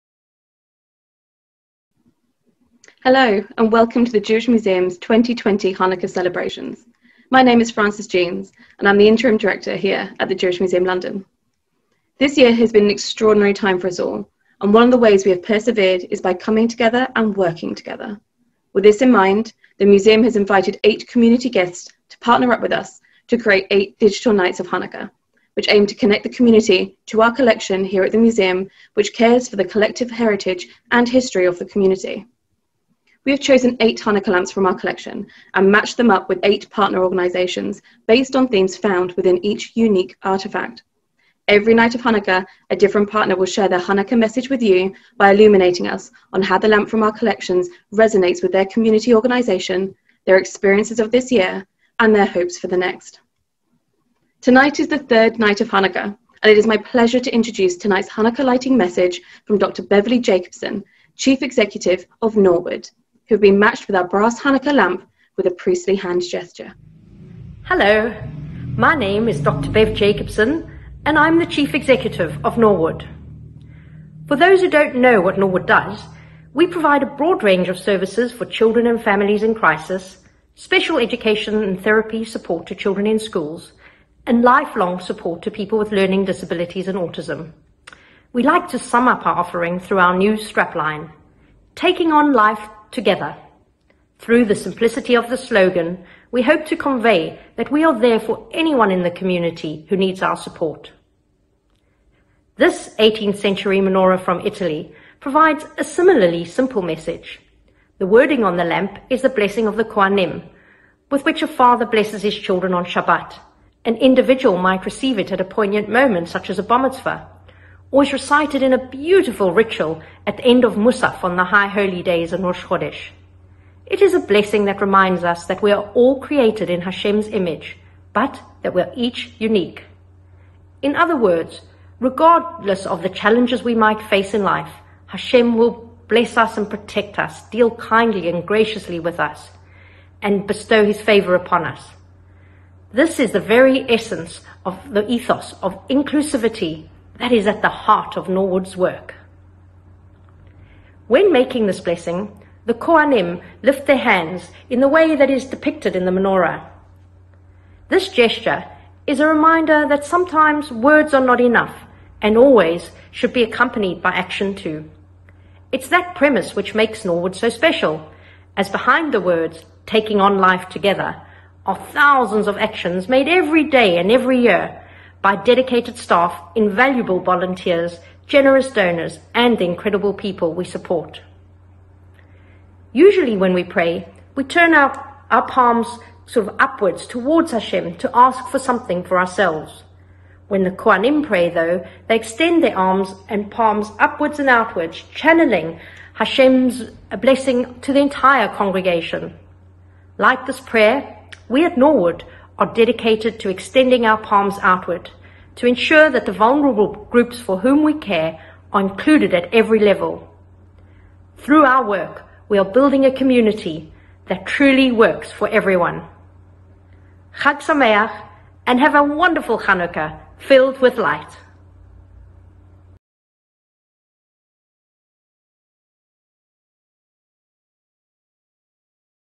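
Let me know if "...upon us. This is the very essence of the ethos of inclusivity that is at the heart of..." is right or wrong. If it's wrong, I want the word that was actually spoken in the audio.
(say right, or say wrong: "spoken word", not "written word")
right.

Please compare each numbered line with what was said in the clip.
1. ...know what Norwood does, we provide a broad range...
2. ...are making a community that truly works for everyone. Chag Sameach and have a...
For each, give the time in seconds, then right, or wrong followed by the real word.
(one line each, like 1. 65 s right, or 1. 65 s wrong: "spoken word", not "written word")
1. 74 s right
2. 212 s wrong: "building", not "making".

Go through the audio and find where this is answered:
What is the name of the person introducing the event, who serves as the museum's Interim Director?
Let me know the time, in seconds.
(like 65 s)
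7 s.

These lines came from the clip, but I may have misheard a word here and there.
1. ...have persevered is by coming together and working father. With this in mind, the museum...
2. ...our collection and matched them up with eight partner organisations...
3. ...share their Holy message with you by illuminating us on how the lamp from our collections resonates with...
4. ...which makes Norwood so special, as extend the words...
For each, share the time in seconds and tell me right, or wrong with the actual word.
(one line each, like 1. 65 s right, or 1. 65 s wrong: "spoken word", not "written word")
1. 15 s wrong: "together", not "father"
2. 34 s right
3. 43 s wrong: "Hanukkah", not "Holy"
4. 166 s wrong: "behind", not "extend".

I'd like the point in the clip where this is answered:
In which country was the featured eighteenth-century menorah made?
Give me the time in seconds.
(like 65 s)
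104 s.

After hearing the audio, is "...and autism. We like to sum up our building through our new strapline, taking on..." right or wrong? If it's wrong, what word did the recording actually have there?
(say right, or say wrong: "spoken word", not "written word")
wrong: "offering", not "building".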